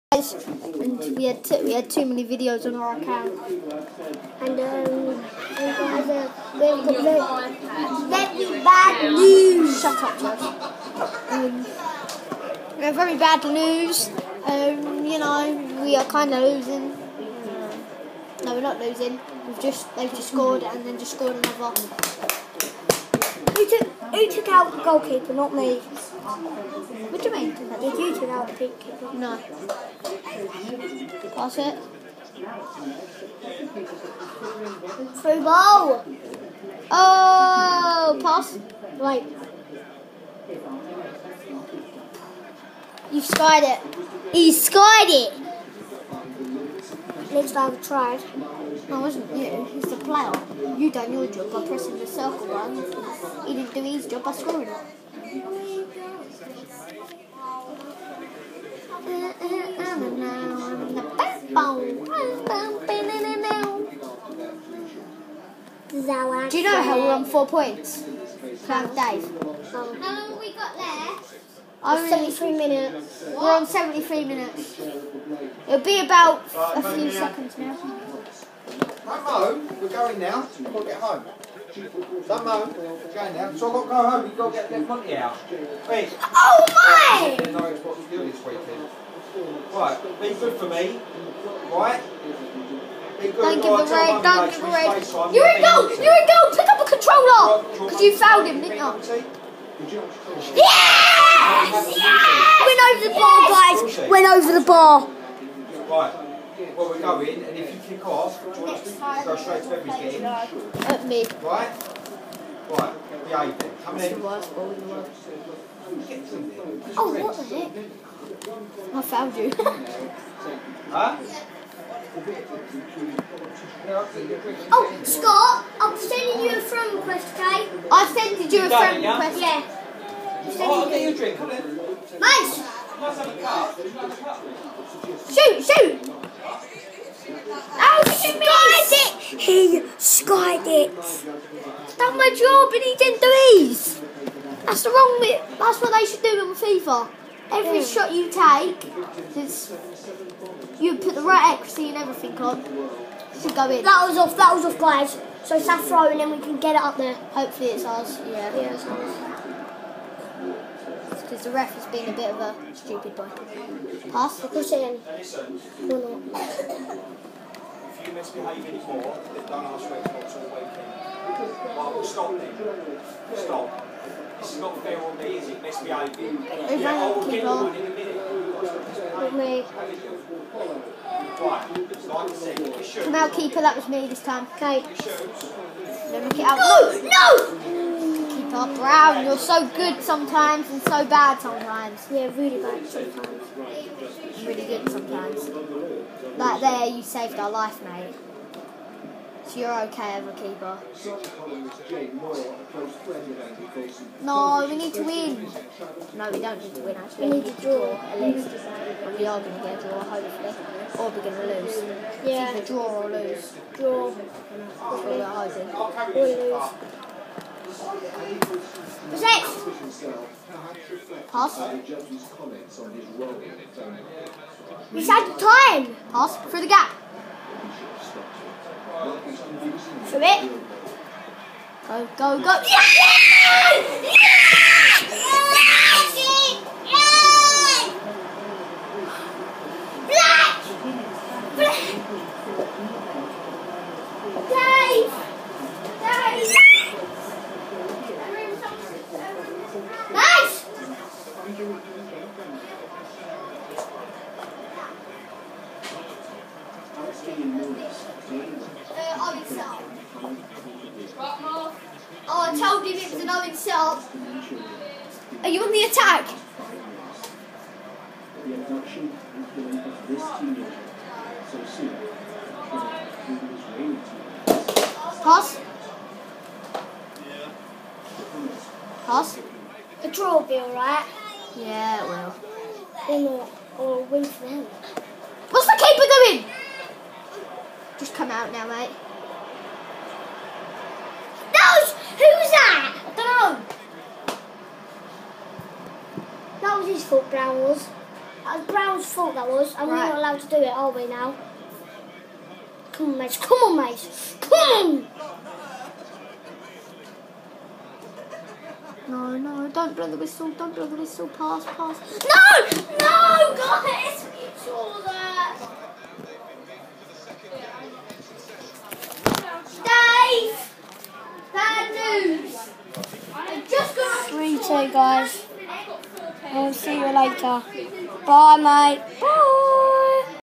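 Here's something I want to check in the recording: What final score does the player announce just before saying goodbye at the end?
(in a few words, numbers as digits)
3-2.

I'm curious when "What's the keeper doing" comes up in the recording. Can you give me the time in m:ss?
4:45.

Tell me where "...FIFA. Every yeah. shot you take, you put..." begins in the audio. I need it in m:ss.
2:26.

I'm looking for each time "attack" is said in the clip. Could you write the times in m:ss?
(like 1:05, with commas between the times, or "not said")
4:25.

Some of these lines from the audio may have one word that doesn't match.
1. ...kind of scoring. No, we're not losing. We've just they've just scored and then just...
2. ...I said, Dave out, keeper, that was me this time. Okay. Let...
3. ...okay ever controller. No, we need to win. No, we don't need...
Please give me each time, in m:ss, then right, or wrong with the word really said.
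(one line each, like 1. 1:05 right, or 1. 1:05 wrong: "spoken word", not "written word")
1. 0:16 wrong: "losing", not "scoring"
2. 3:02 wrong: "Come", not "Dave"
3. 3:19 wrong: "keeper", not "controller".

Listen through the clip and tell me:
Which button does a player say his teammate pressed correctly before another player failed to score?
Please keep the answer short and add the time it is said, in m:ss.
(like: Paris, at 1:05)
Circle, at 0:52.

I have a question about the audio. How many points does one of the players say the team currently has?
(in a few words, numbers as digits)
4.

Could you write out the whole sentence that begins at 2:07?
I sent you a friend request.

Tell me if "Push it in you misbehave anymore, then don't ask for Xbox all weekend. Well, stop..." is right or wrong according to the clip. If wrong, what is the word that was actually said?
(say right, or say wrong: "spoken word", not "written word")
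right.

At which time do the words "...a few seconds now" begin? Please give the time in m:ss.
1:16.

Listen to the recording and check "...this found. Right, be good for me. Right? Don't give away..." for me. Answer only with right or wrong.
wrong.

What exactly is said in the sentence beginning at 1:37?
Because you fouled him, didn't you?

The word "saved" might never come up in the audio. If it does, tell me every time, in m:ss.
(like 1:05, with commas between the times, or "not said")
3:17.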